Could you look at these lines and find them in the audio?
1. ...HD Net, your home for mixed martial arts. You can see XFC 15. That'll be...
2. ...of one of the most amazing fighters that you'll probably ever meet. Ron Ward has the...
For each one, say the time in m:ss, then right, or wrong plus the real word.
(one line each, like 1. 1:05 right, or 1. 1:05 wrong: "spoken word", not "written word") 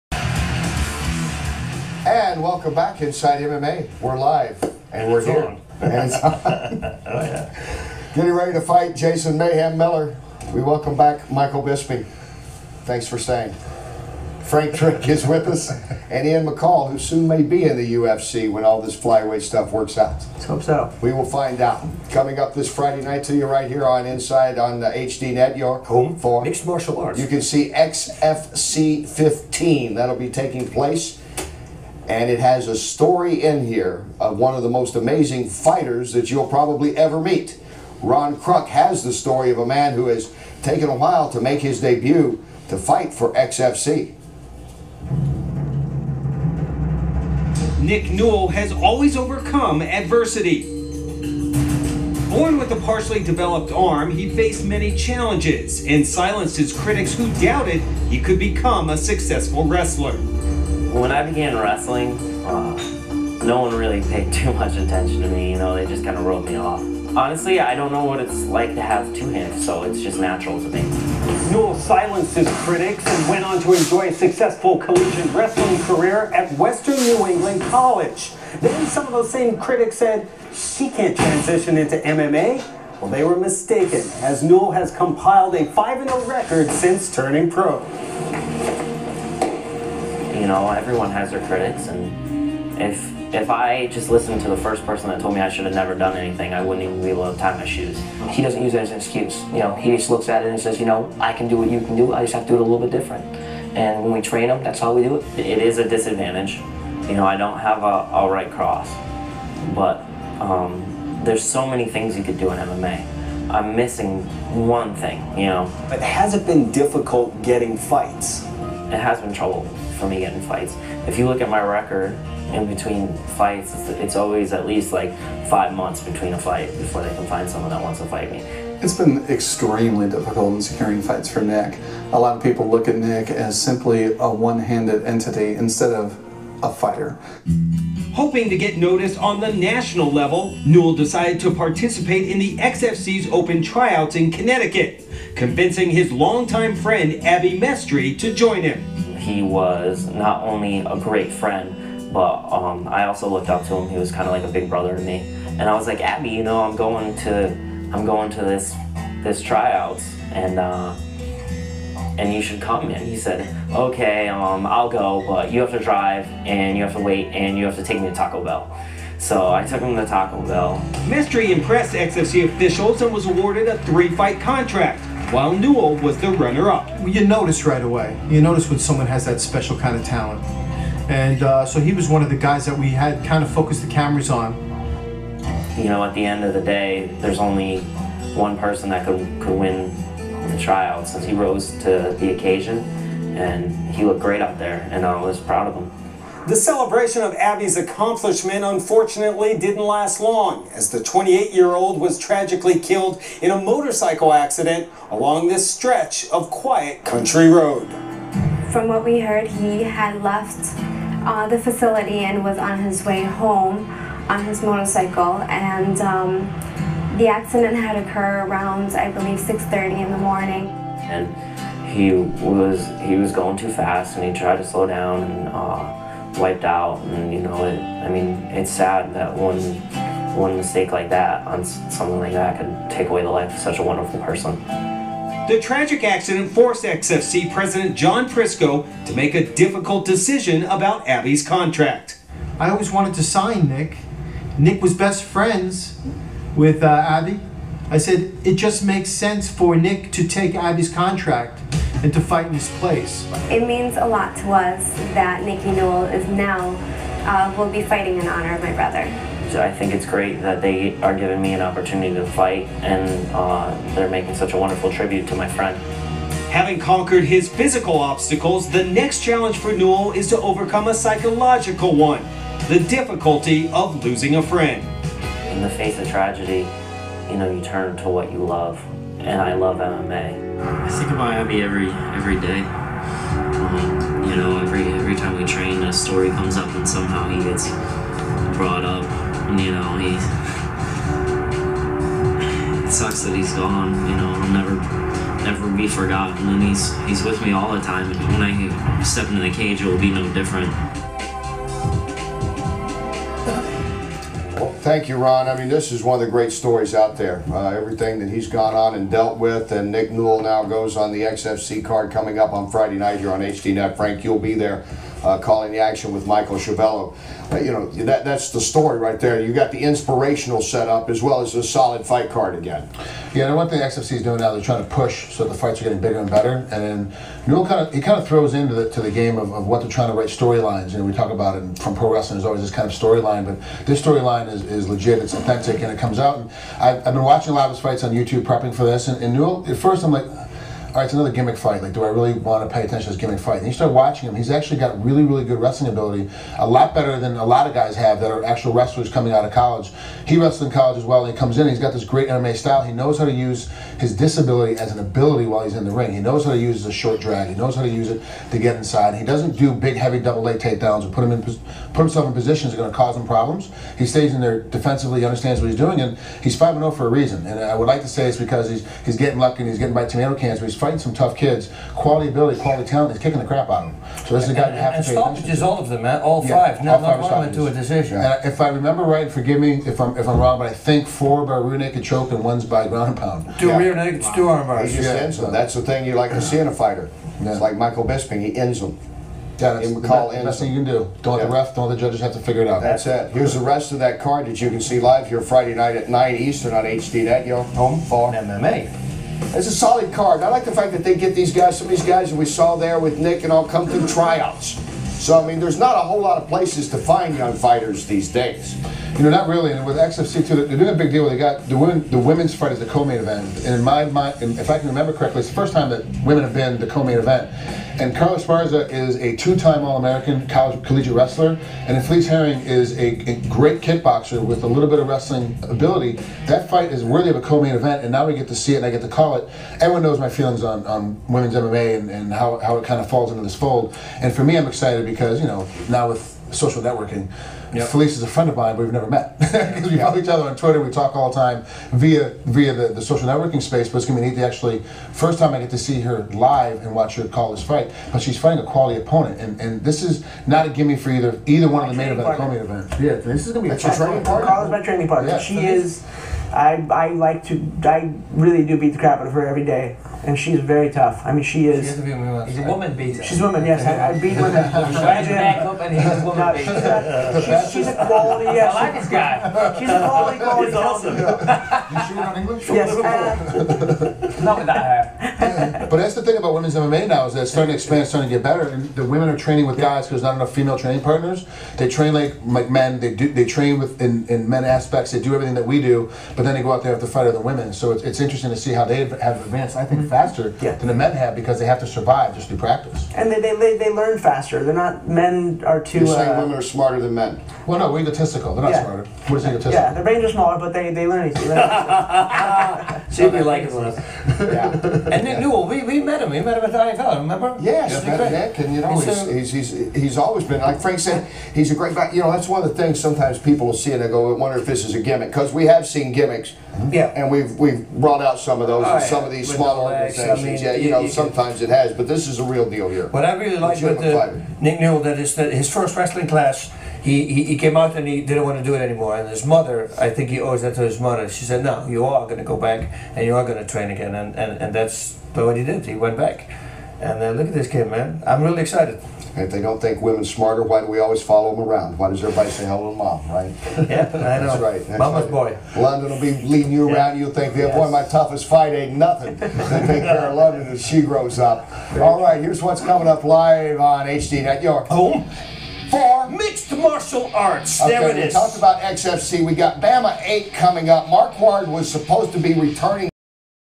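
1. 0:24 right
2. 0:34 wrong: "Kruck", not "Ward".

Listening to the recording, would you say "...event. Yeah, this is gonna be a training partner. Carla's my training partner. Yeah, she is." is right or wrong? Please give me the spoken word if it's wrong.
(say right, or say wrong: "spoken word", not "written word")
right.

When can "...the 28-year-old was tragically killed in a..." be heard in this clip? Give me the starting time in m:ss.
3:20.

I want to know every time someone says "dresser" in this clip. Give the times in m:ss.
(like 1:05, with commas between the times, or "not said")
not said.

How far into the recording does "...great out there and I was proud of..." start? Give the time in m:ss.
3:14.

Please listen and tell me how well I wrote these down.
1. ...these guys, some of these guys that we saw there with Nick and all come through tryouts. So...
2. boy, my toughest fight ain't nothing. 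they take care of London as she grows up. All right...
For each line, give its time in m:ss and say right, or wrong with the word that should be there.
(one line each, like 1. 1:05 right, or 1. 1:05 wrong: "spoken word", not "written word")
1. 6:41 right
2. 9:07 right.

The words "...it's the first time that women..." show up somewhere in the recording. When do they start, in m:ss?
6:55.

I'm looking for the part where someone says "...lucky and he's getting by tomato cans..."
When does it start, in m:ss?
6:09.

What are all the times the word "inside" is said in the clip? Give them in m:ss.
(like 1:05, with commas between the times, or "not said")
0:03, 0:24, 5:58.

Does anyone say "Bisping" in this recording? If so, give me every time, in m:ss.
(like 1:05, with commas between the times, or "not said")
0:11, 6:28.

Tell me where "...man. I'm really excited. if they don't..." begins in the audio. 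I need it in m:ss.
8:57.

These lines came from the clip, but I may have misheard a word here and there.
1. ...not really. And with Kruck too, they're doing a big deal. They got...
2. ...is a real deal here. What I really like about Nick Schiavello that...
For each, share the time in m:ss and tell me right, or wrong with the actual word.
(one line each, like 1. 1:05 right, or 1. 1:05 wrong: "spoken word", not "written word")
1. 6:49 wrong: "XFC", not "Kruck"
2. 8:42 wrong: "Newell", not "Schiavello".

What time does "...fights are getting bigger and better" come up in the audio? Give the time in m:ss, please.
5:25.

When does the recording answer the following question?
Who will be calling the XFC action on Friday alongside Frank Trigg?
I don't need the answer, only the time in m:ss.
5:16.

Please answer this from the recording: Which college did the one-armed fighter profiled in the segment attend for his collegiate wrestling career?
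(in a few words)
Western New England College.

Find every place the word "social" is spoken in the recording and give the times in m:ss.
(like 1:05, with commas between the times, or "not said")
7:16, 7:23.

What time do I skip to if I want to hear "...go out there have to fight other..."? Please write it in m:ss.
8:06.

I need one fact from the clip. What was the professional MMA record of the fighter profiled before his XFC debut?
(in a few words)
5-0.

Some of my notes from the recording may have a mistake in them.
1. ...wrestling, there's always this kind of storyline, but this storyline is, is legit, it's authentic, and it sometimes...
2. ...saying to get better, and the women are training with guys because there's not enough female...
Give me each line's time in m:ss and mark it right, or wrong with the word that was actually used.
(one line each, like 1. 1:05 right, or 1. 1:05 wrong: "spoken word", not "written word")
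1. 5:32 wrong: "comes", not "sometimes"
2. 7:58 wrong: "starting", not "saying".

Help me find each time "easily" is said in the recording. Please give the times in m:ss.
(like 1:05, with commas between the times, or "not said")
8:21.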